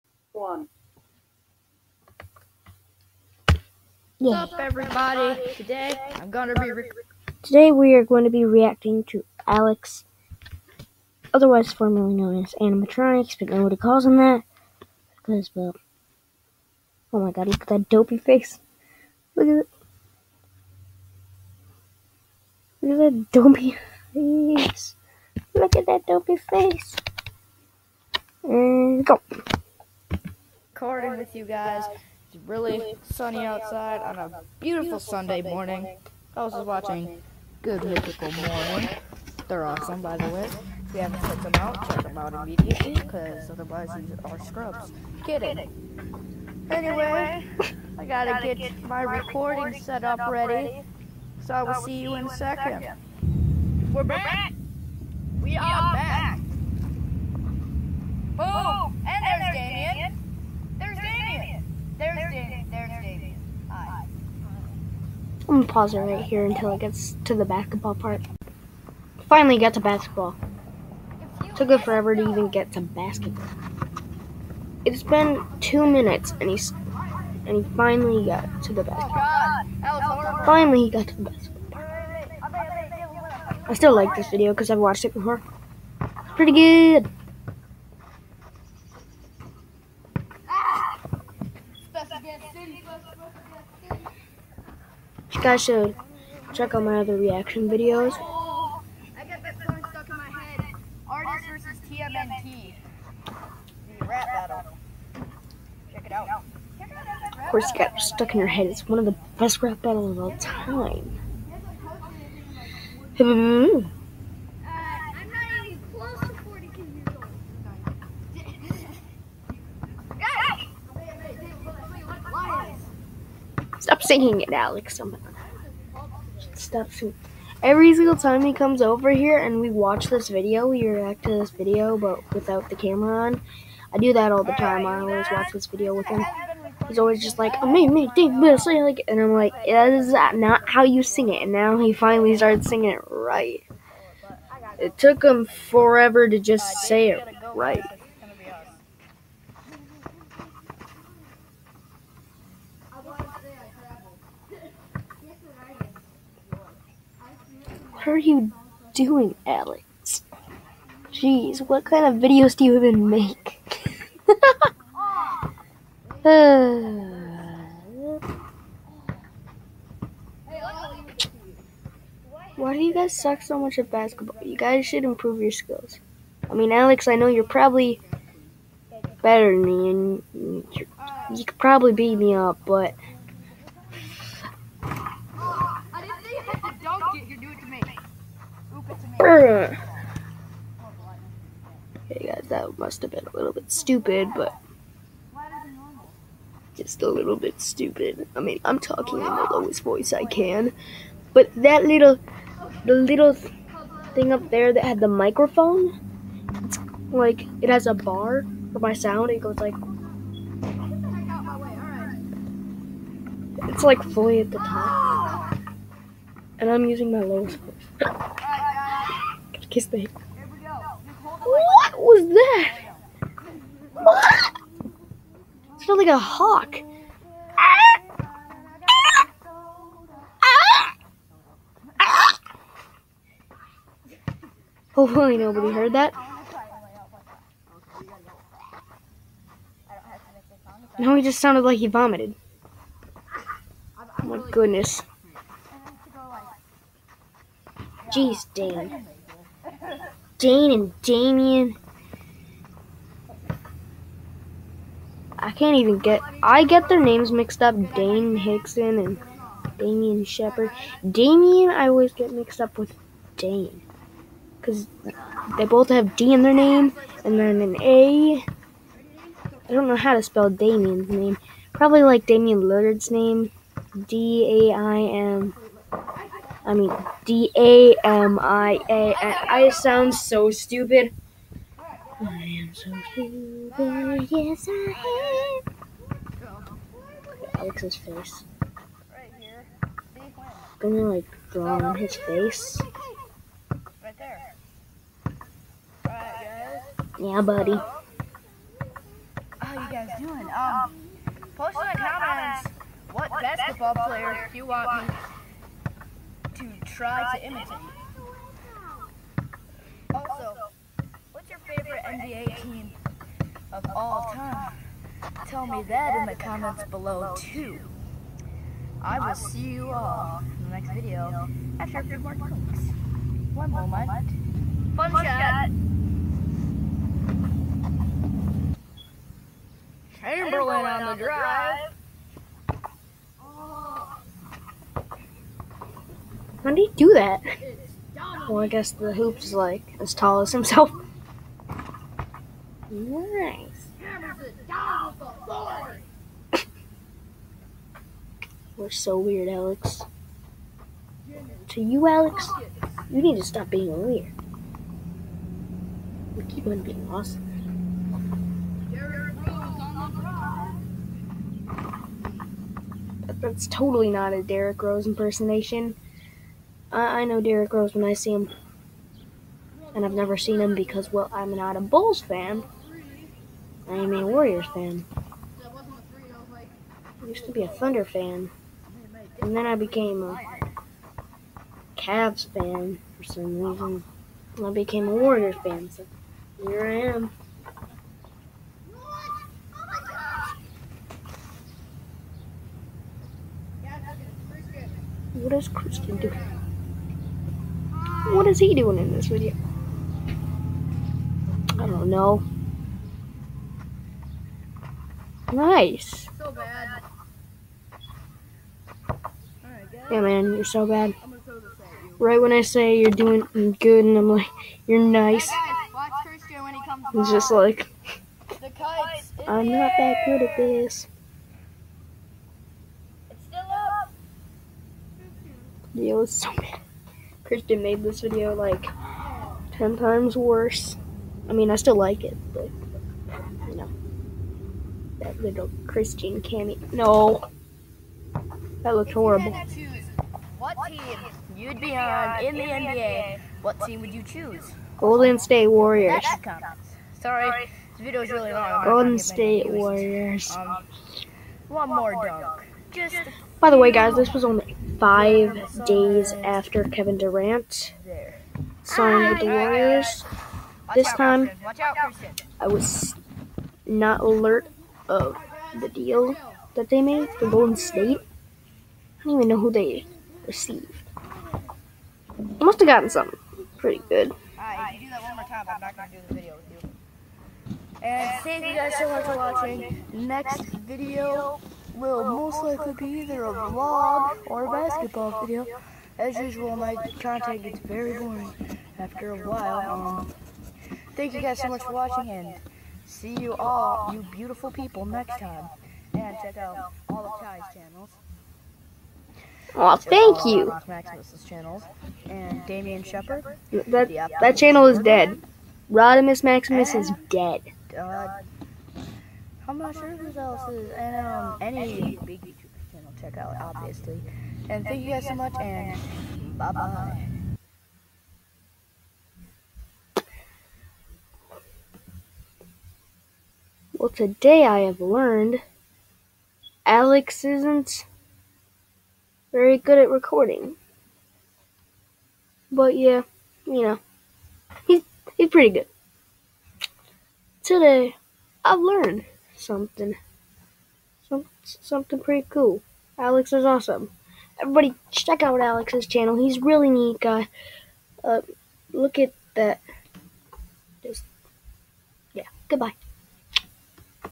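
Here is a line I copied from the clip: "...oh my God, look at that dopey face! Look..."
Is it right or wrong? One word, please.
right.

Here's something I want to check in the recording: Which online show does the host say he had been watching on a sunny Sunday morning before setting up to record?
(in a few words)
Good Mythical Morning.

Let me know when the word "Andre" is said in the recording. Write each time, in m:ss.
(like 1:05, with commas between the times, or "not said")
not said.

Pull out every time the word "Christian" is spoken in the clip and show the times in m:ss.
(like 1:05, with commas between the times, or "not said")
6:35, 7:07, 7:15.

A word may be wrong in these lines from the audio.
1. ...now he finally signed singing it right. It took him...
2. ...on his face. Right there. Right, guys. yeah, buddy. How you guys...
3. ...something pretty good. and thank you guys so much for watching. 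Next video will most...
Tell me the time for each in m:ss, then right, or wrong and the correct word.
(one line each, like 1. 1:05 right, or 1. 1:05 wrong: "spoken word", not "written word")
1. 2:21 wrong: "started", not "signed"
2. 4:51 right
3. 7:53 right.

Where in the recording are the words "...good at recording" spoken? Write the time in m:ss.
8:49.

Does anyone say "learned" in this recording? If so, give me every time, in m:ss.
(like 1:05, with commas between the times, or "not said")
8:44, 8:58.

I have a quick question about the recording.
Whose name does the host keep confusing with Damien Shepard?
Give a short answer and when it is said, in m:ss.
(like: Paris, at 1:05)
Dane Hickson, at 4:17.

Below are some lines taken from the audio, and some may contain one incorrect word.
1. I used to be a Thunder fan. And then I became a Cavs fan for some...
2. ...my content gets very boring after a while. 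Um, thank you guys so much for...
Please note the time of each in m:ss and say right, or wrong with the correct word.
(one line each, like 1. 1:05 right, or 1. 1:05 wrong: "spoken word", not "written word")
1. 6:15 right
2. 8:06 right.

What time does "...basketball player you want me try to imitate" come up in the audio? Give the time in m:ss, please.
5:03.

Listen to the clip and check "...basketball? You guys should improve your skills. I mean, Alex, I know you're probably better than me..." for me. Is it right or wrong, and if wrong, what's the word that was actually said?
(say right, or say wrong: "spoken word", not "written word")
right.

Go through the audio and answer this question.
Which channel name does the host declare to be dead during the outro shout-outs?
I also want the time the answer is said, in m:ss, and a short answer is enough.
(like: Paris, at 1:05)
Rodimus Maximus, at 8:25.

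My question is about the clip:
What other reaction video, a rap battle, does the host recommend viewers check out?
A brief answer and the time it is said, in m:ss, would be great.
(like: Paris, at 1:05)
Artist versus TMNT, at 1:41.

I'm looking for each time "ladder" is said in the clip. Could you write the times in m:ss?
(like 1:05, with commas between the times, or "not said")
not said.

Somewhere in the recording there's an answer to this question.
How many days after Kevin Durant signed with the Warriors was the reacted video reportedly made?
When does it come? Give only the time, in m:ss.
7:34.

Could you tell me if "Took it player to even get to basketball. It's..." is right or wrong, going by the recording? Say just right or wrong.
wrong.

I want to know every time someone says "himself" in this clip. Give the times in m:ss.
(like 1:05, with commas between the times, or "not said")
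5:40.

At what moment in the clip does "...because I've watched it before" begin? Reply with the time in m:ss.
1:24.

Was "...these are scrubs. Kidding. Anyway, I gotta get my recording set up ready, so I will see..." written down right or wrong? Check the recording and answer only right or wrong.
right.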